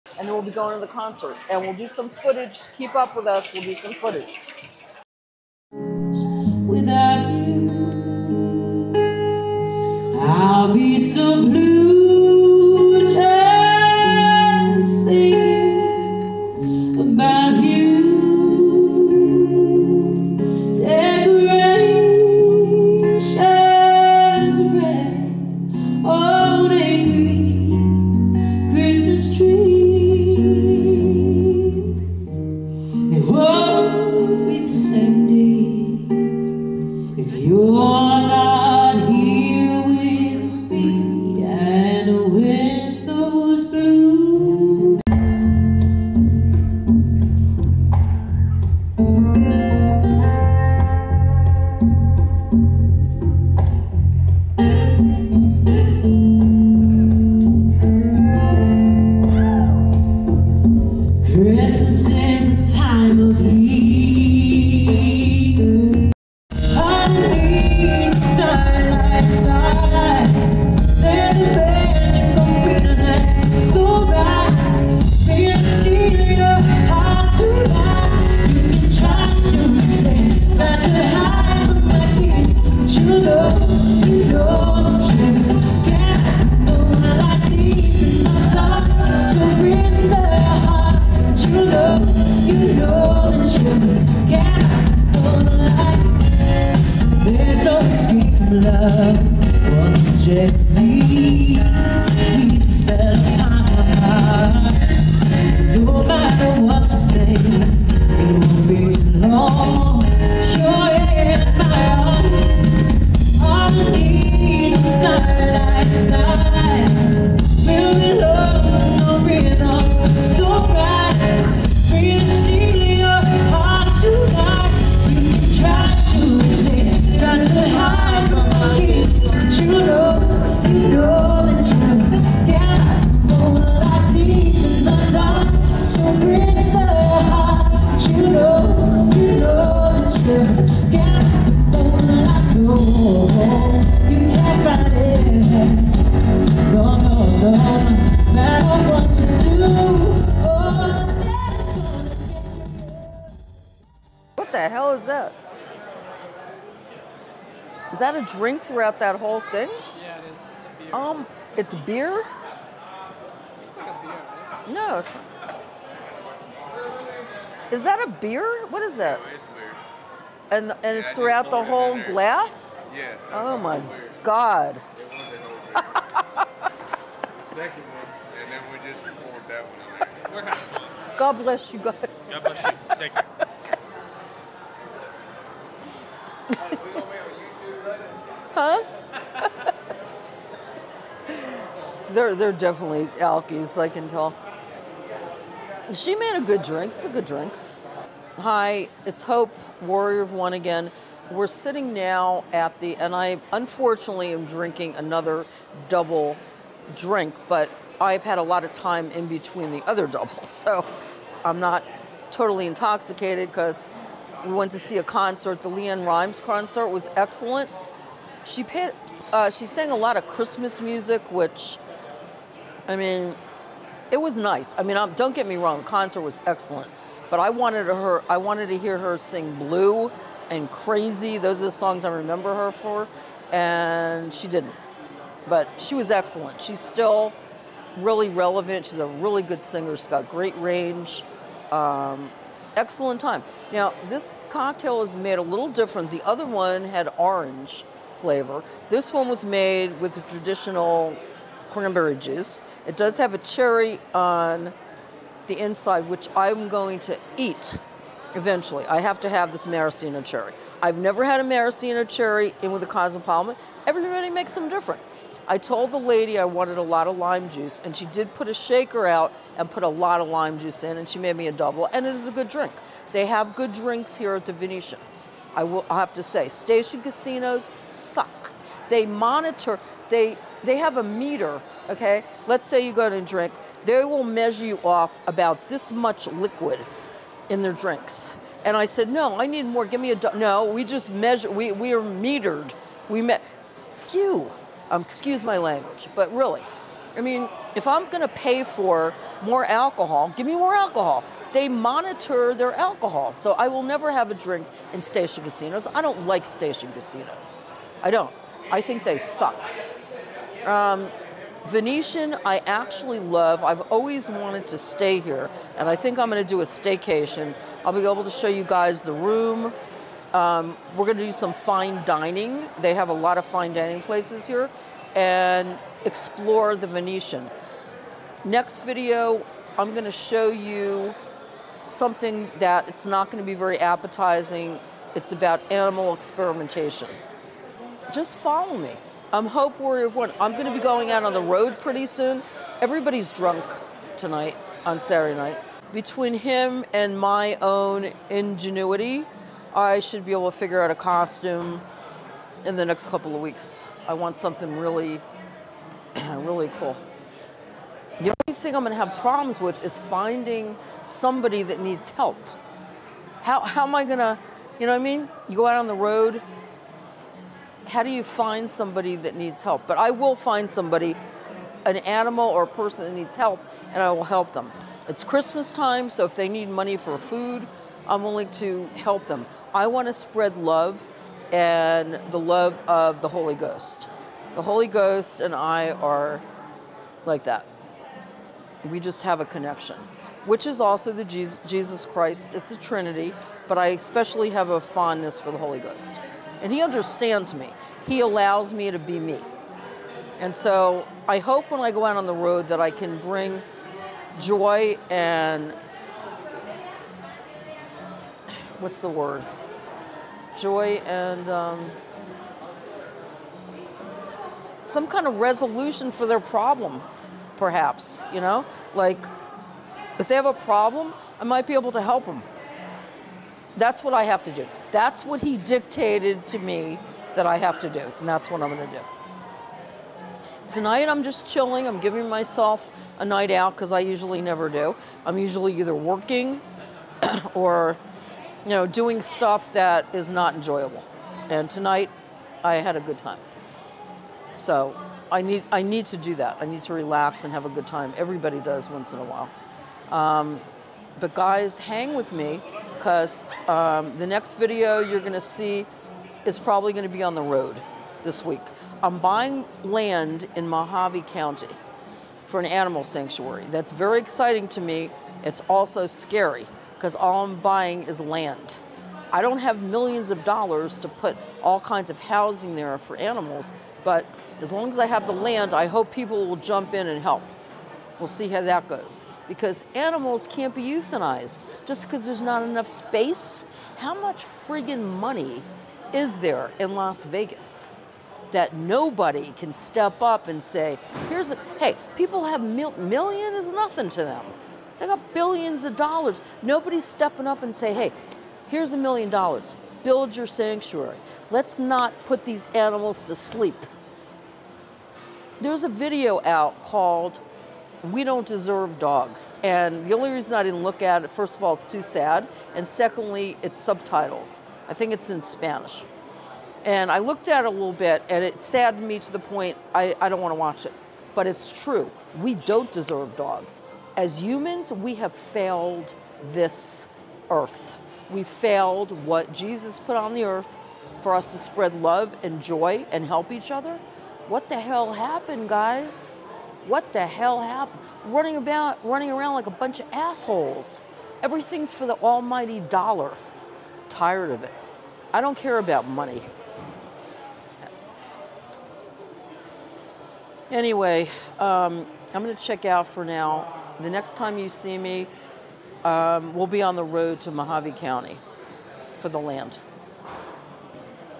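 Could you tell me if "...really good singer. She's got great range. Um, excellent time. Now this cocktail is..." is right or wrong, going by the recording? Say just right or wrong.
right.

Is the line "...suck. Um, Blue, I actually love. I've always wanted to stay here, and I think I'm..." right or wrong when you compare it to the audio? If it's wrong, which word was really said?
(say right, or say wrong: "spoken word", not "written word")
wrong: "Venetian", not "Blue".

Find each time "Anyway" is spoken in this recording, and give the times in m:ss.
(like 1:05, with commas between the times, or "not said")
9:10.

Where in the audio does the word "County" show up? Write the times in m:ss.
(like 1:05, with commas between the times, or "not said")
7:41, 9:17.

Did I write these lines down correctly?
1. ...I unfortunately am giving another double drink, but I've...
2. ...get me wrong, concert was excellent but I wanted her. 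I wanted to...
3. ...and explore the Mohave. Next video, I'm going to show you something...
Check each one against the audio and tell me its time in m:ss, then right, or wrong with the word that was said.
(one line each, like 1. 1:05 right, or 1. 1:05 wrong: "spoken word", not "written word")
1. 3:23 wrong: "drinking", not "giving"
2. 3:45 right
3. 5:25 wrong: "Venetian", not "Mohave".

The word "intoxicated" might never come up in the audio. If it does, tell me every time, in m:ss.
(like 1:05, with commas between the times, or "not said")
3:32.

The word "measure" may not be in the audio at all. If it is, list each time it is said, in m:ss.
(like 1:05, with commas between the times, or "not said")
4:44, 4:51.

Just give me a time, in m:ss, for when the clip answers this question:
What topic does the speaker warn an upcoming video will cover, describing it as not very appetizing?
5:35.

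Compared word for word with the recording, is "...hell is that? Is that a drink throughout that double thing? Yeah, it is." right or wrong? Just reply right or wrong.
wrong.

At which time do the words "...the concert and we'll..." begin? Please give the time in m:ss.
0:00.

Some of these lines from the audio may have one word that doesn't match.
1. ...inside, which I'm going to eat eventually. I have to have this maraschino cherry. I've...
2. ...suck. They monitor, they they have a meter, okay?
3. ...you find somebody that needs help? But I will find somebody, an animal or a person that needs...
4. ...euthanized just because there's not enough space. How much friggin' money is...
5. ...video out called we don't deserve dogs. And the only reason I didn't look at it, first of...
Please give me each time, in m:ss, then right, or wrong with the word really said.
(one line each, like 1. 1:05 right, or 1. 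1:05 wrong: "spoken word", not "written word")
1. 4:15 right
2. 4:37 right
3. 6:08 right
4. 8:00 right
5. 8:25 right.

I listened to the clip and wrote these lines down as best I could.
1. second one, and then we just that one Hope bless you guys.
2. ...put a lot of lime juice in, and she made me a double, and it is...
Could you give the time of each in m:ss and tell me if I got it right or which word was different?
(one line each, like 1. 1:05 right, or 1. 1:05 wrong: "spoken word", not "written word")
1. 2:54 wrong: "God", not "Hope"
2. 4:29 right.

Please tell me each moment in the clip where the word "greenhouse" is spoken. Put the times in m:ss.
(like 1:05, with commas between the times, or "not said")
not said.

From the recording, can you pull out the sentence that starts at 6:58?
Like, if they have a problem, I might be able to help them.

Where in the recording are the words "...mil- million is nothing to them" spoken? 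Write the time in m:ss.
8:12.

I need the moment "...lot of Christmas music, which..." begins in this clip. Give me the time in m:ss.
3:39.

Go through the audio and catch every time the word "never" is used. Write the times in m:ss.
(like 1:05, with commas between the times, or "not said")
4:20, 5:03, 7:14.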